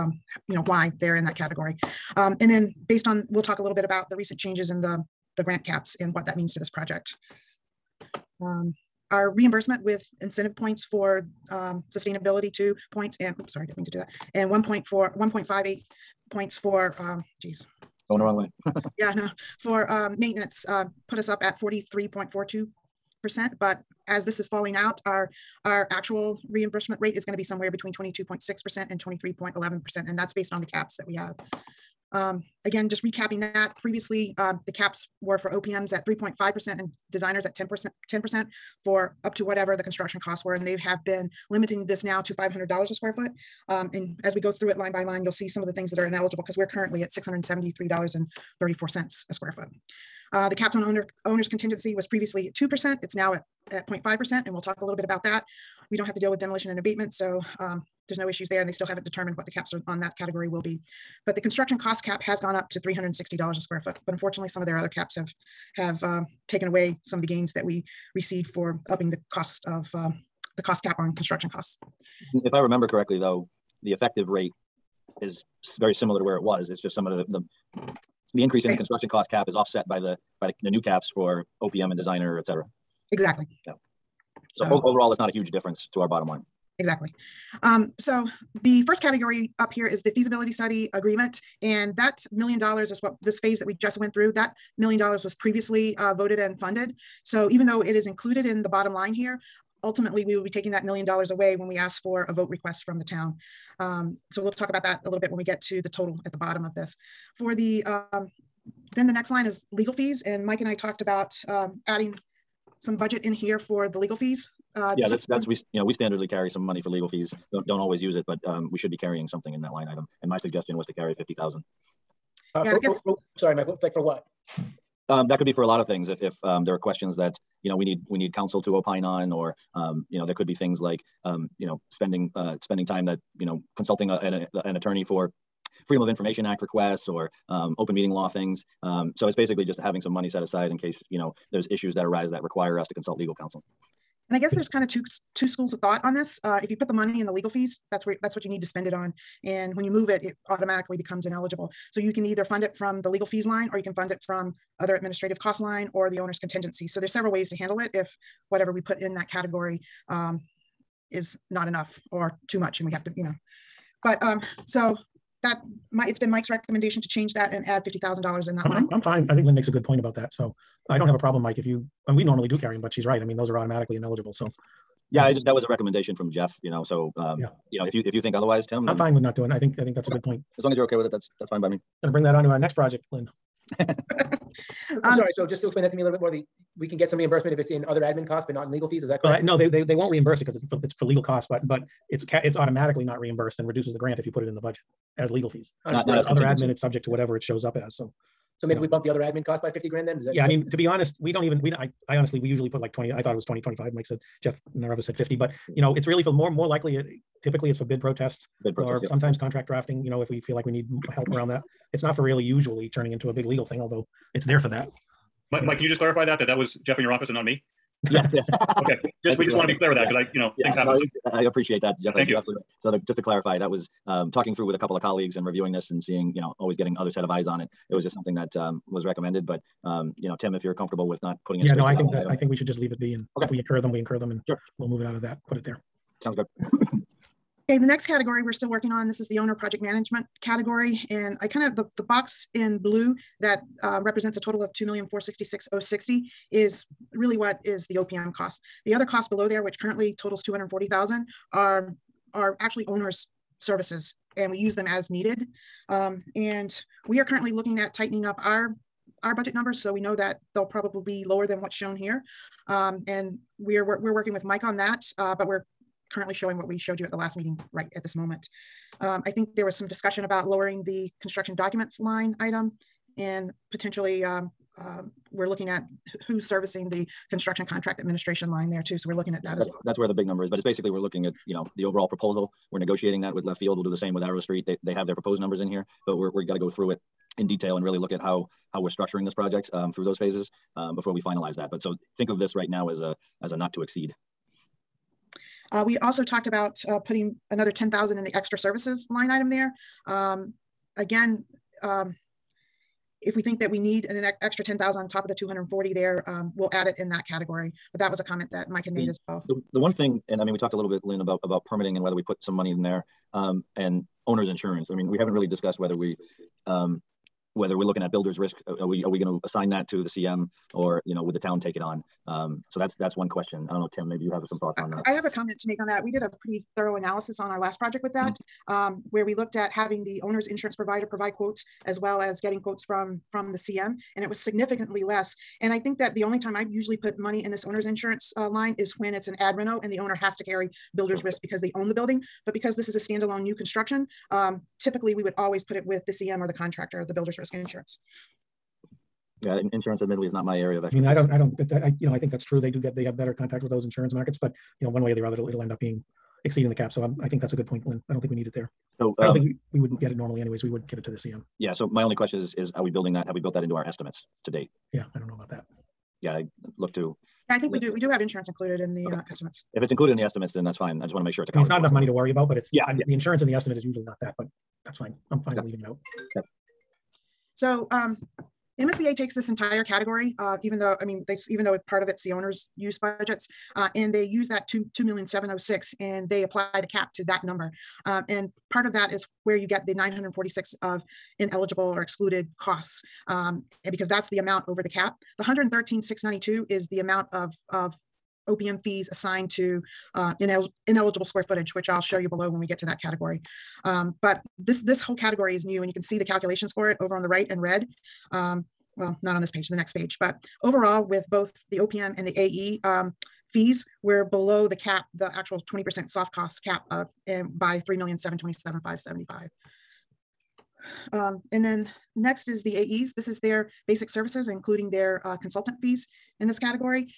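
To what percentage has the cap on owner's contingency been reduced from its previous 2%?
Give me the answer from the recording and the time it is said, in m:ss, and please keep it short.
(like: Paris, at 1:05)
0.5%, at 0:53.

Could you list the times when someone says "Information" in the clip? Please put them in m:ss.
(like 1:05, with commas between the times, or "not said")
2:16.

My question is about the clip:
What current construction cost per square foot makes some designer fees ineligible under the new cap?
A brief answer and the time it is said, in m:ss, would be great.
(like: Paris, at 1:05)
$673.34, at 0:47.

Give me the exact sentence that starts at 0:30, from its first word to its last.
And that's based on the caps that we have.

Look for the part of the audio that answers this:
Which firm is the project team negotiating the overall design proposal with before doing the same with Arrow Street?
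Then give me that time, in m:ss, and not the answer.
4:43.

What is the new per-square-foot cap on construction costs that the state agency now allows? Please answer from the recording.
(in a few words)
$360.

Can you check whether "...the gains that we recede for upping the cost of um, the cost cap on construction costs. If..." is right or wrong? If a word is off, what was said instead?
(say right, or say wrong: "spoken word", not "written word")
right.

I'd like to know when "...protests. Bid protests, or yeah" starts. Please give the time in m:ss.
3:28.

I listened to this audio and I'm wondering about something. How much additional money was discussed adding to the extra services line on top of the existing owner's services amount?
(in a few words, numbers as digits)
$10,000.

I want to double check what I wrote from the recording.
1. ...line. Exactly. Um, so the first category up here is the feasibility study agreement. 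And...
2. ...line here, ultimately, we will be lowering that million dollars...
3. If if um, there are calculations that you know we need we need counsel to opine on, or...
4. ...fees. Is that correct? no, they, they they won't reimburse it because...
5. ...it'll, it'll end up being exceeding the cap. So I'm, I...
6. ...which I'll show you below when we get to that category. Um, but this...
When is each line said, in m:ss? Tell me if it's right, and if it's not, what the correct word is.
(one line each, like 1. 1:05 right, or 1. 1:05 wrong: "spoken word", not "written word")
1. 1:26 right
2. 1:38 wrong: "taking", not "lowering"
3. 2:06 wrong: "questions", not "calculations"
4. 3:08 right
5. 5:55 right
6. 6:41 right.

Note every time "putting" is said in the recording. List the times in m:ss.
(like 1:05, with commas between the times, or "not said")
3:51, 4:57.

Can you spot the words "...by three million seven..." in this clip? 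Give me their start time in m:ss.
6:57.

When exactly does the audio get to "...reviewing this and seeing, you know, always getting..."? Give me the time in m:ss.
3:45.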